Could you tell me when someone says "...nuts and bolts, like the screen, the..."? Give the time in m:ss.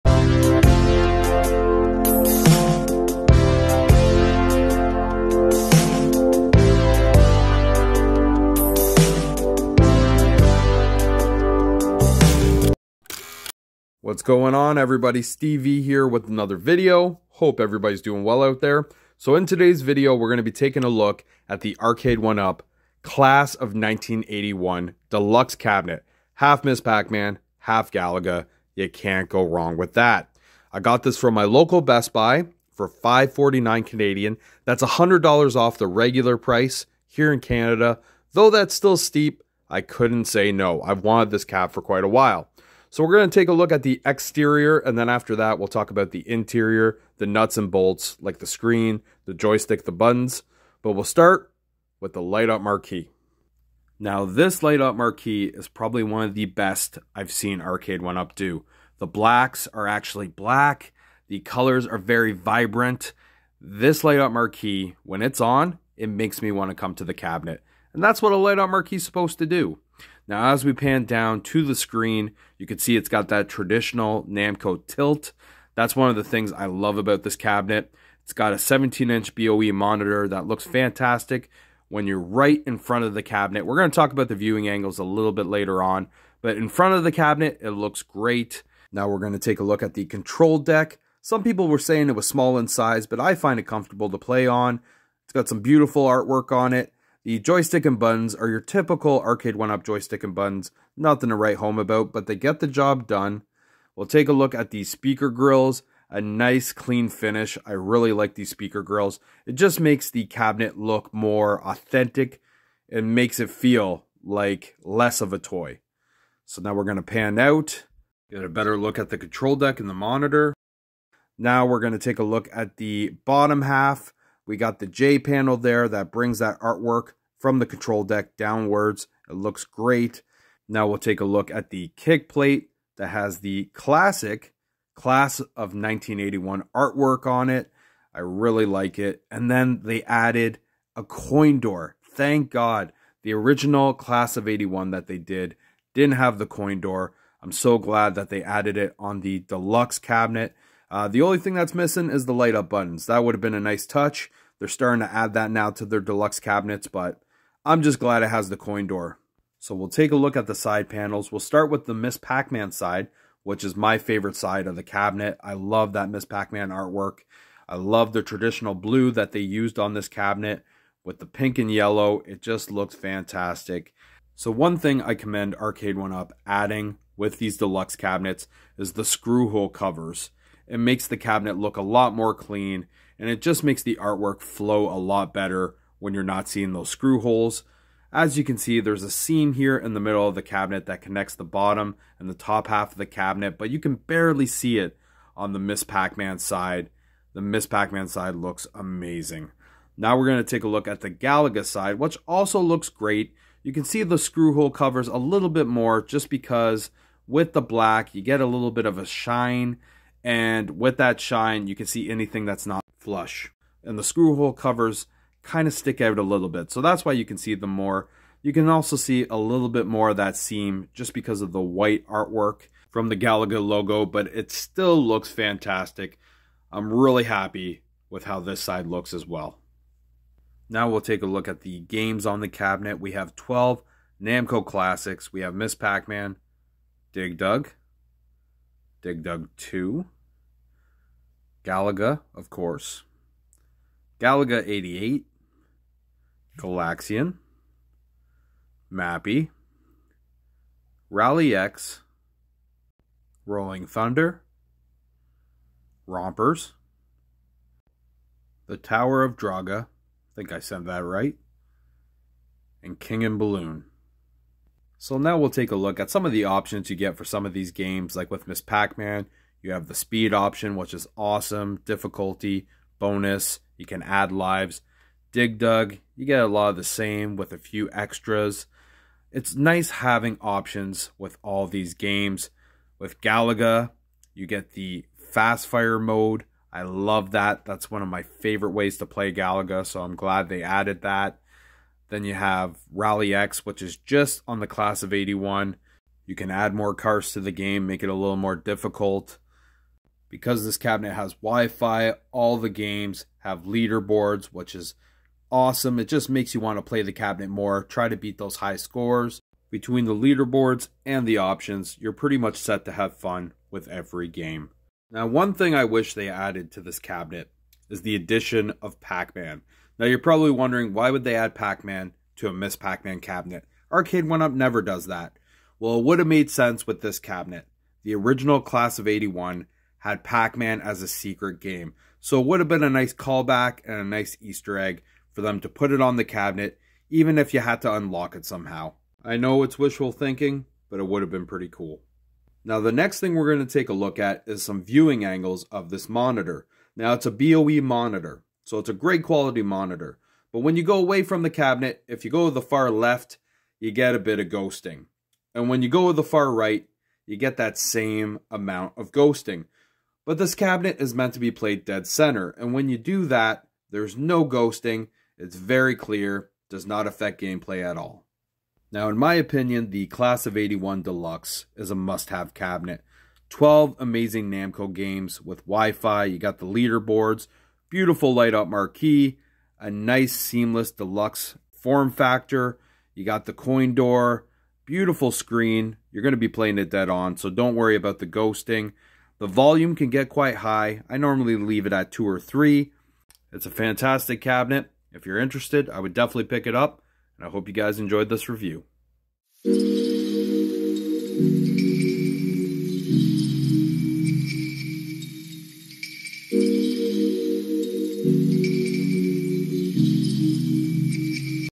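0:47.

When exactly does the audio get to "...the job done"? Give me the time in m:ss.
1:42.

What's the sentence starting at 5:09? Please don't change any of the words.
Between the leaderboards and the options, you're pretty much set to have fun with every game.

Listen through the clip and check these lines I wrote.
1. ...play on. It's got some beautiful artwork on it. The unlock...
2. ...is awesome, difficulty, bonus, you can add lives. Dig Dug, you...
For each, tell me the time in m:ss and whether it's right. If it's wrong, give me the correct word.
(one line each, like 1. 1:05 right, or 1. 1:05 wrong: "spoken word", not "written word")
1. 1:34 wrong: "joystick", not "unlock"
2. 4:30 right.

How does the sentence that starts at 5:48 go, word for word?
So it's a great quality monitor.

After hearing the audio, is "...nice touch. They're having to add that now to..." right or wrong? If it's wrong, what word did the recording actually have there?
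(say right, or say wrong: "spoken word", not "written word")
wrong: "starting", not "having".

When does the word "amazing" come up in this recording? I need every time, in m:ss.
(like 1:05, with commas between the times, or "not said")
3:18, 6:13.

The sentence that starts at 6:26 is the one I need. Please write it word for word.
You're going to be playing it dead on, so don't worry about the ghosting.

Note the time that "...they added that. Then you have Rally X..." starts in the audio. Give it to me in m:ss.
4:50.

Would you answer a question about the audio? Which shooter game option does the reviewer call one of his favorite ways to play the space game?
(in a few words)
Fast fire mode.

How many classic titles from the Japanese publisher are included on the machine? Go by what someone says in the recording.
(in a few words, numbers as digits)
12.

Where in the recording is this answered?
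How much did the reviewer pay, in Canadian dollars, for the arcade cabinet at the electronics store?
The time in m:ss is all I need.
0:32.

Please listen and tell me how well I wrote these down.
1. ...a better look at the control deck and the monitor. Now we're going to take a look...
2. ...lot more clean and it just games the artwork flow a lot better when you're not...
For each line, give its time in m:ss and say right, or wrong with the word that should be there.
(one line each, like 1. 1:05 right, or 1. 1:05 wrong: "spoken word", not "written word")
1. 1:58 right
2. 3:01 wrong: "makes", not "games".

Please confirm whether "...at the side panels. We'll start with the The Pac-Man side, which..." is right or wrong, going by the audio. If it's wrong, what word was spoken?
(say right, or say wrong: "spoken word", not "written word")
wrong: "Miss", not "The".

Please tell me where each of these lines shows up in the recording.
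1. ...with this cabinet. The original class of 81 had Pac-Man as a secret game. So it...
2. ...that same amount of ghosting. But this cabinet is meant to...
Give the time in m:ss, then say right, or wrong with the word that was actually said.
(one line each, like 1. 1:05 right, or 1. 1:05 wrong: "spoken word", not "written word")
1. 5:26 right
2. 5:57 right.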